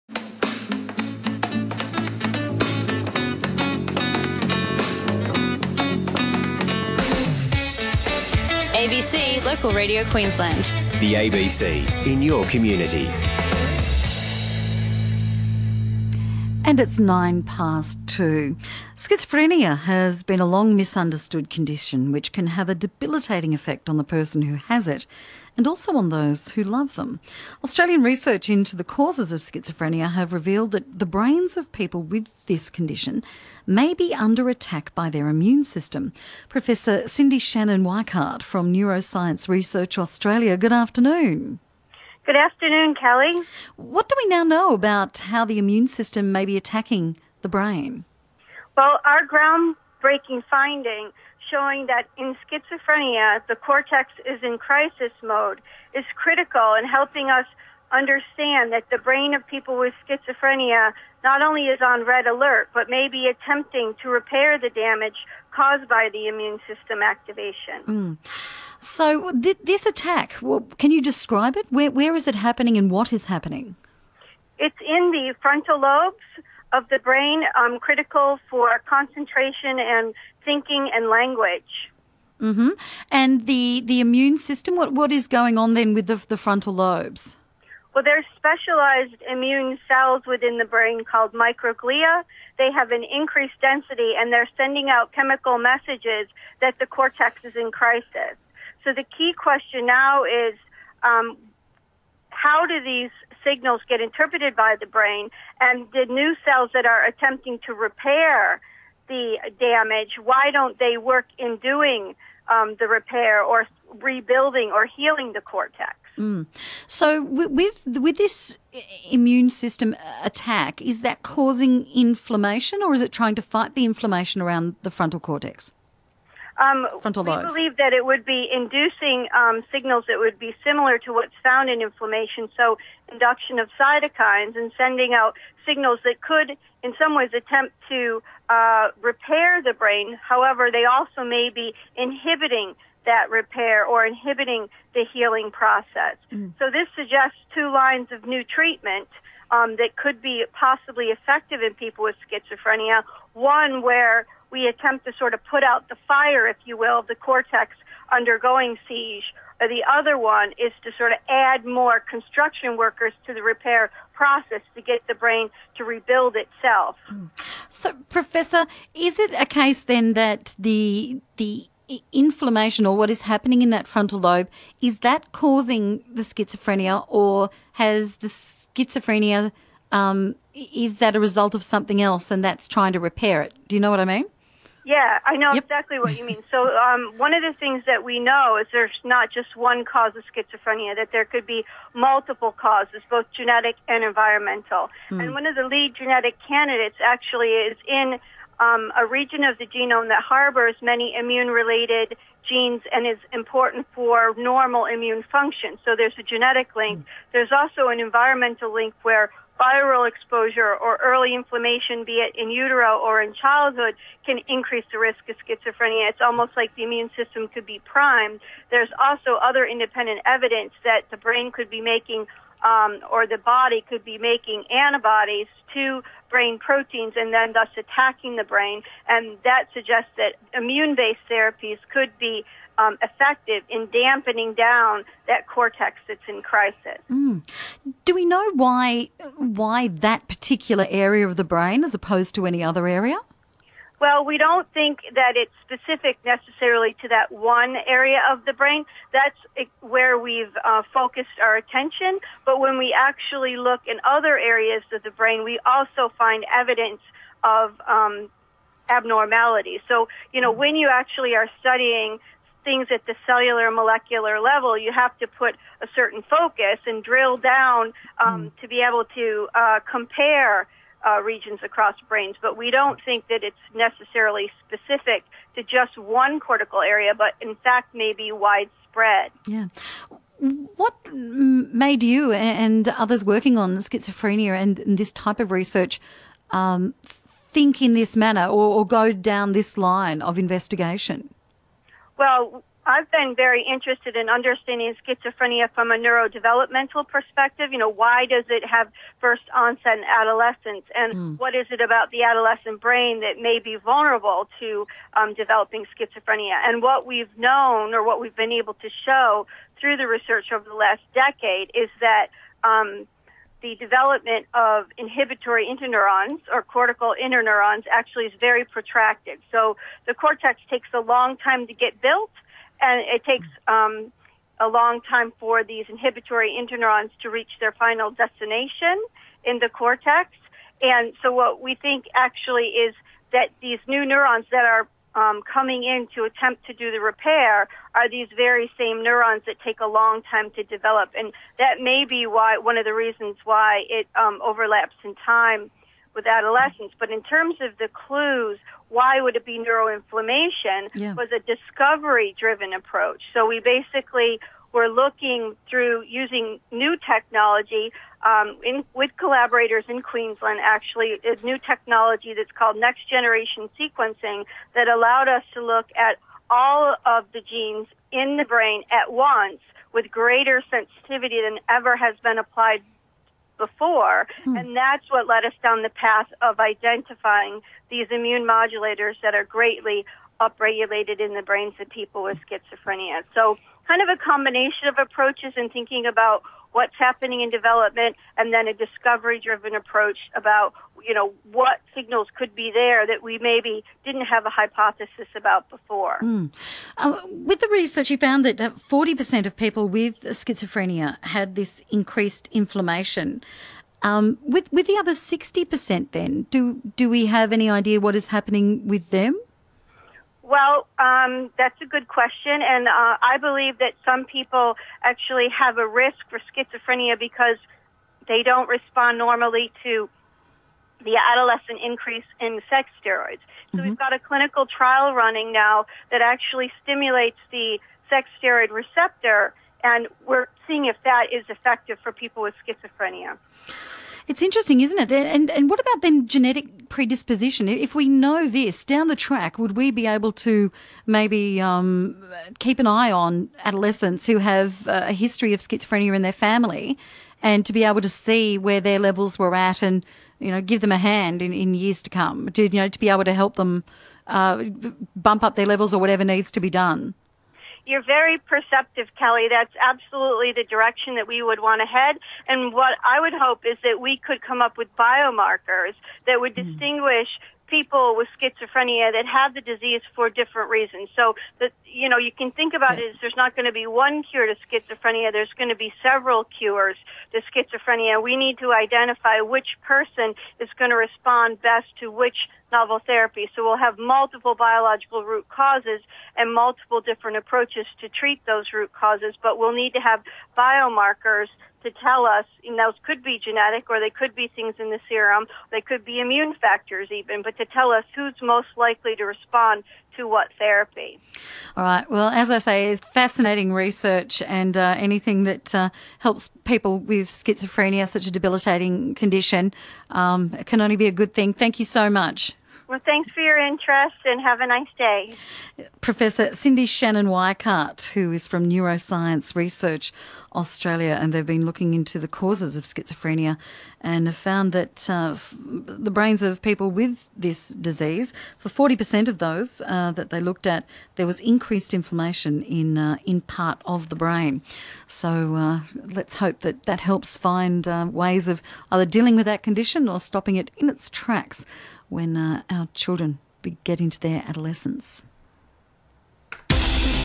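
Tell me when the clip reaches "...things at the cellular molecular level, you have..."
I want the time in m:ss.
4:22.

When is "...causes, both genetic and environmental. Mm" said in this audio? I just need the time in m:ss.
3:12.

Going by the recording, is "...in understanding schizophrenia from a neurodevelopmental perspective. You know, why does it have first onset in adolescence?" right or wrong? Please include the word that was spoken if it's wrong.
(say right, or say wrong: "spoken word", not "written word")
right.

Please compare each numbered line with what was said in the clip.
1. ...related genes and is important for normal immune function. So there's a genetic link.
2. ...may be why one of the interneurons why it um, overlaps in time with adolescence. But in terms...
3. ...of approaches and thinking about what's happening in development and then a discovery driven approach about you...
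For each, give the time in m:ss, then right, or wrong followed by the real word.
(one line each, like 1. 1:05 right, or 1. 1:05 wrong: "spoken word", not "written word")
1. 3:21 right
2. 5:41 wrong: "reasons", not "interneurons"
3. 6:24 right.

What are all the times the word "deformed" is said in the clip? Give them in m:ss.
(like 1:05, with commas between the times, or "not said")
not said.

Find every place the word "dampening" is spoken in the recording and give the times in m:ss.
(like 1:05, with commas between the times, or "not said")
3:53.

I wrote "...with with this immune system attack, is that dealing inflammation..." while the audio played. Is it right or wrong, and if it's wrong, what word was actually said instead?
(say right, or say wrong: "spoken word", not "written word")
wrong: "causing", not "dealing".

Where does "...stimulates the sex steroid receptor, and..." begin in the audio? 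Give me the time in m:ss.
7:06.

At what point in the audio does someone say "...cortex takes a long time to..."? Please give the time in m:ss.
5:20.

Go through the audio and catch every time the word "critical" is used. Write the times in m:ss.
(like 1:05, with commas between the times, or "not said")
0:56, 1:17.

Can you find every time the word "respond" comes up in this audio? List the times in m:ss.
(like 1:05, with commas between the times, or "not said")
6:58, 8:01, 8:19.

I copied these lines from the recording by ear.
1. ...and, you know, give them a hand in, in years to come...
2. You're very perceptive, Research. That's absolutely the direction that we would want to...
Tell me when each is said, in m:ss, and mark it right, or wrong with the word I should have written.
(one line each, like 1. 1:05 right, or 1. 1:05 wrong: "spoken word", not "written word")
1. 7:29 right
2. 7:37 wrong: "Kelly", not "Research".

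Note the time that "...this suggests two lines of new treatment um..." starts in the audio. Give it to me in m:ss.
2:26.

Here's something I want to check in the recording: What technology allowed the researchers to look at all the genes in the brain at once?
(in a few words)
Next generation sequencing.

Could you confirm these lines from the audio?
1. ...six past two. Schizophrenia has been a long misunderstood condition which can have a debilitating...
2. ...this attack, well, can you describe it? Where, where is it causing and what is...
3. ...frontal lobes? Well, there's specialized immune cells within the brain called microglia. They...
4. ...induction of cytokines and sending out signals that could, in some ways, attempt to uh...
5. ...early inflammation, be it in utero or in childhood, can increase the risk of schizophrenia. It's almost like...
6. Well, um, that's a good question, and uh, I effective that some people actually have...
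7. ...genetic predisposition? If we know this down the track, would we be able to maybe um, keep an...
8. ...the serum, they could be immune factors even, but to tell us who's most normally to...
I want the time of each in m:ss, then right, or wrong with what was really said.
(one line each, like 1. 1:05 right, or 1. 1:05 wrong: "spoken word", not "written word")
1. 0:16 wrong: "nine", not "six"
2. 1:09 wrong: "happening", not "causing"
3. 1:26 right
4. 2:13 right
5. 3:31 right
6. 6:50 wrong: "believe", not "effective"
7. 7:16 right
8. 8:14 wrong: "likely", not "normally".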